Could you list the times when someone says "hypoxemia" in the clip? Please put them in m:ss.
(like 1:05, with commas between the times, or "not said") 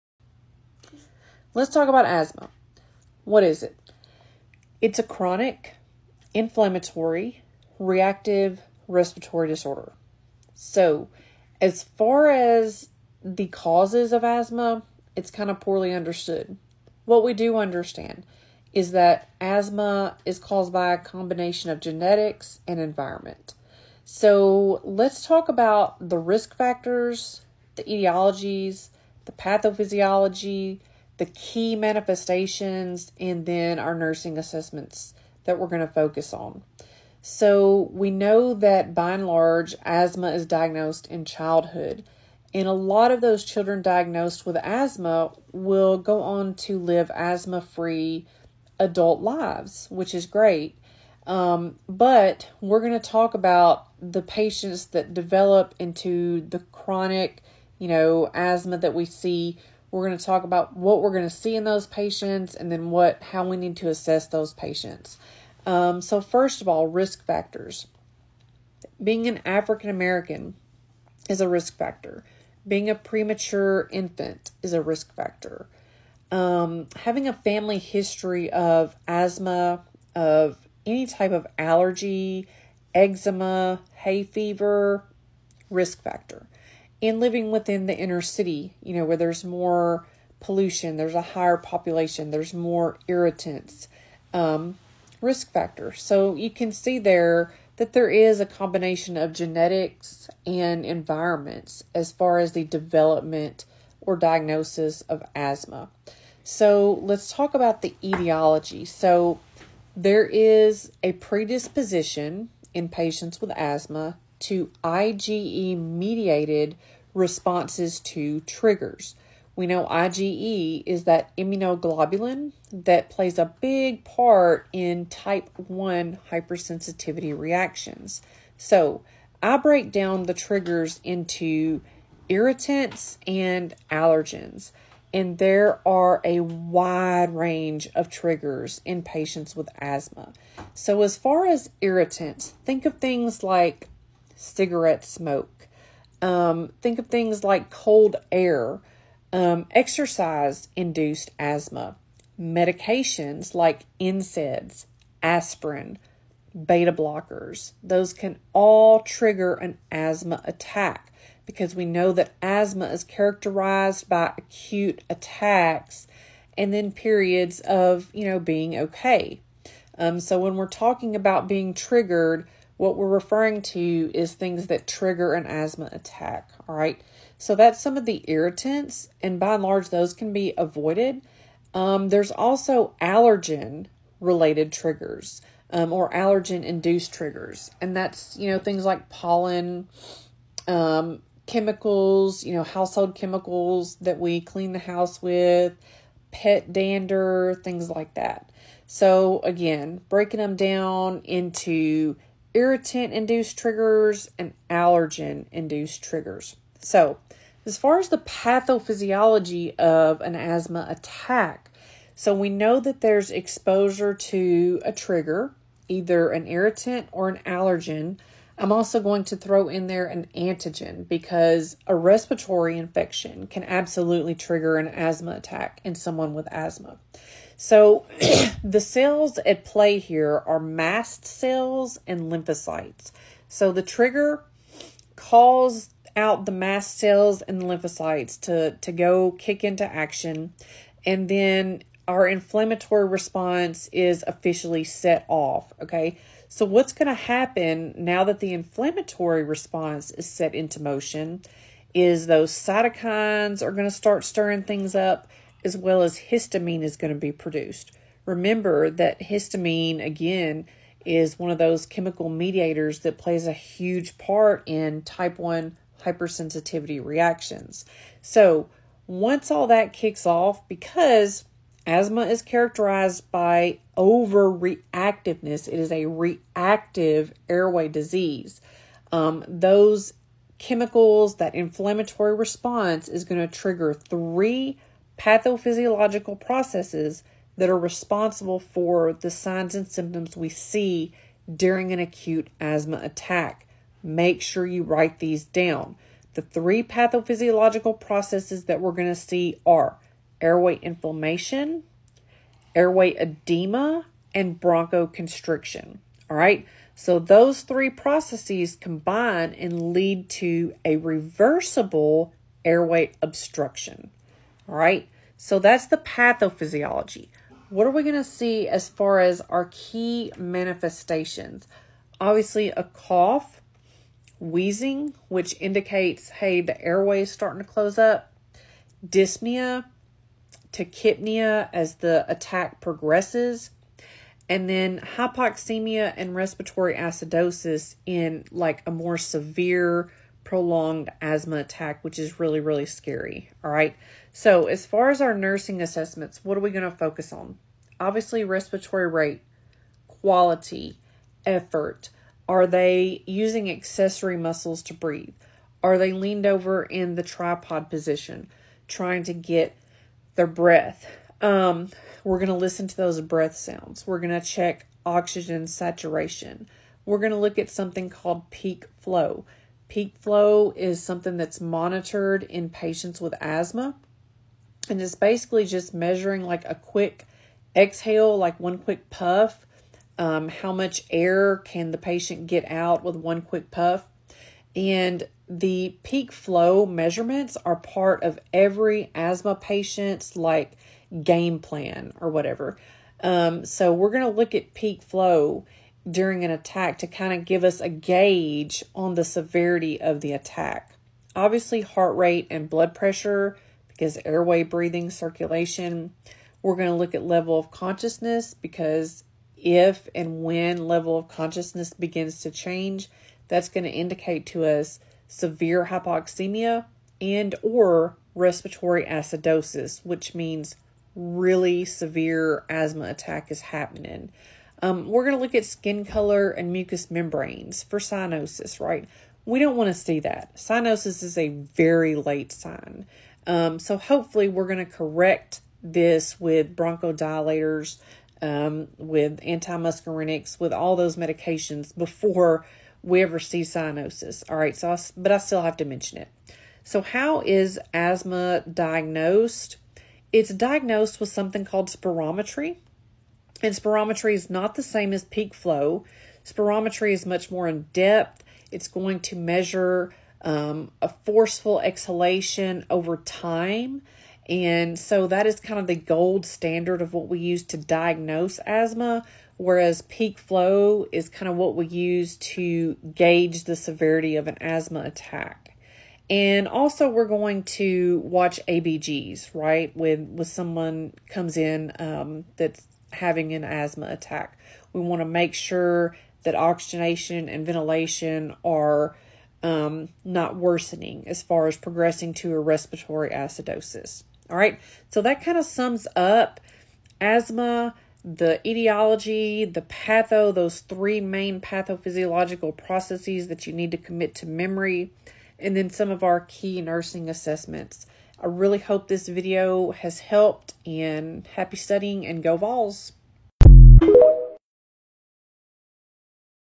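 5:35, 6:55.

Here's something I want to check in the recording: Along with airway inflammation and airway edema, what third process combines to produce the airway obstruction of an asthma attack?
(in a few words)
bronchoconstriction.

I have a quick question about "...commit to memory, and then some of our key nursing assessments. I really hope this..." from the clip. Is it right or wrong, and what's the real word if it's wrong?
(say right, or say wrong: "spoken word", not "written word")
right.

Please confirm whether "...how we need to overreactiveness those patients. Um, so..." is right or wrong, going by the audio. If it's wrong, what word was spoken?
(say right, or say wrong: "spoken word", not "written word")
wrong: "assess", not "overreactiveness".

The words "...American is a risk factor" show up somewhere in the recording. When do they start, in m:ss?
1:09.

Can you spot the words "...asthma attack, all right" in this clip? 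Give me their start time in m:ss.
2:55.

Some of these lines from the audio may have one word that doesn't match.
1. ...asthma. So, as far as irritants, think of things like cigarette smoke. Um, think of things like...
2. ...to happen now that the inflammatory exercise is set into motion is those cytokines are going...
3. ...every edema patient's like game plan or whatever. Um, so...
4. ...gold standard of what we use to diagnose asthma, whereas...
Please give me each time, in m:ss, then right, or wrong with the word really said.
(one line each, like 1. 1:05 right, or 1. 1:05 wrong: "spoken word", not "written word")
1. 2:19 right
2. 4:07 wrong: "response", not "exercise"
3. 6:28 wrong: "asthma", not "edema"
4. 7:45 right.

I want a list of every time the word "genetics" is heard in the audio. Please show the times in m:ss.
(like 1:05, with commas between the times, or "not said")
0:21, 1:39.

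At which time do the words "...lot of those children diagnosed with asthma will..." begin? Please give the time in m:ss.
0:42.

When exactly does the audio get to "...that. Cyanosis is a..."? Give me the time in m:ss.
7:10.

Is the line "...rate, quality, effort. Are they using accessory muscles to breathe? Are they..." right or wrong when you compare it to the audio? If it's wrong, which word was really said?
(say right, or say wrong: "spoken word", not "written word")
right.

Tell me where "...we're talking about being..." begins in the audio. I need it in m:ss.
2:50.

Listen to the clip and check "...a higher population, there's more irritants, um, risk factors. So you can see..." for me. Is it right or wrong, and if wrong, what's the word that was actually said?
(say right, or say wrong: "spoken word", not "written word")
right.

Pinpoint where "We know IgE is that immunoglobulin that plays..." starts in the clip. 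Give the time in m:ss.
1:59.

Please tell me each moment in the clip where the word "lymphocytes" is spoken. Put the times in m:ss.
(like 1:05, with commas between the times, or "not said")
3:52, 3:57.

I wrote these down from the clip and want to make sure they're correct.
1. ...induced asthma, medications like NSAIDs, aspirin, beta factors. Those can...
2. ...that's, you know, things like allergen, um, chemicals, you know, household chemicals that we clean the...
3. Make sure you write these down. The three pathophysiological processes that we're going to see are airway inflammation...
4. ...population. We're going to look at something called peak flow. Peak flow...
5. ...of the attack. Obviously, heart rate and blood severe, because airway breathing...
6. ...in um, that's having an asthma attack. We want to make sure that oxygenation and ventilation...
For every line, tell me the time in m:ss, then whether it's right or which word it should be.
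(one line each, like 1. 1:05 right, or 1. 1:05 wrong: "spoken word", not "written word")
1. 2:30 wrong: "blockers", not "factors"
2. 3:07 wrong: "pollen", not "allergen"
3. 4:54 right
4. 6:05 wrong: "saturation", not "population"
5. 6:39 wrong: "pressure", not "severe"
6. 8:01 right.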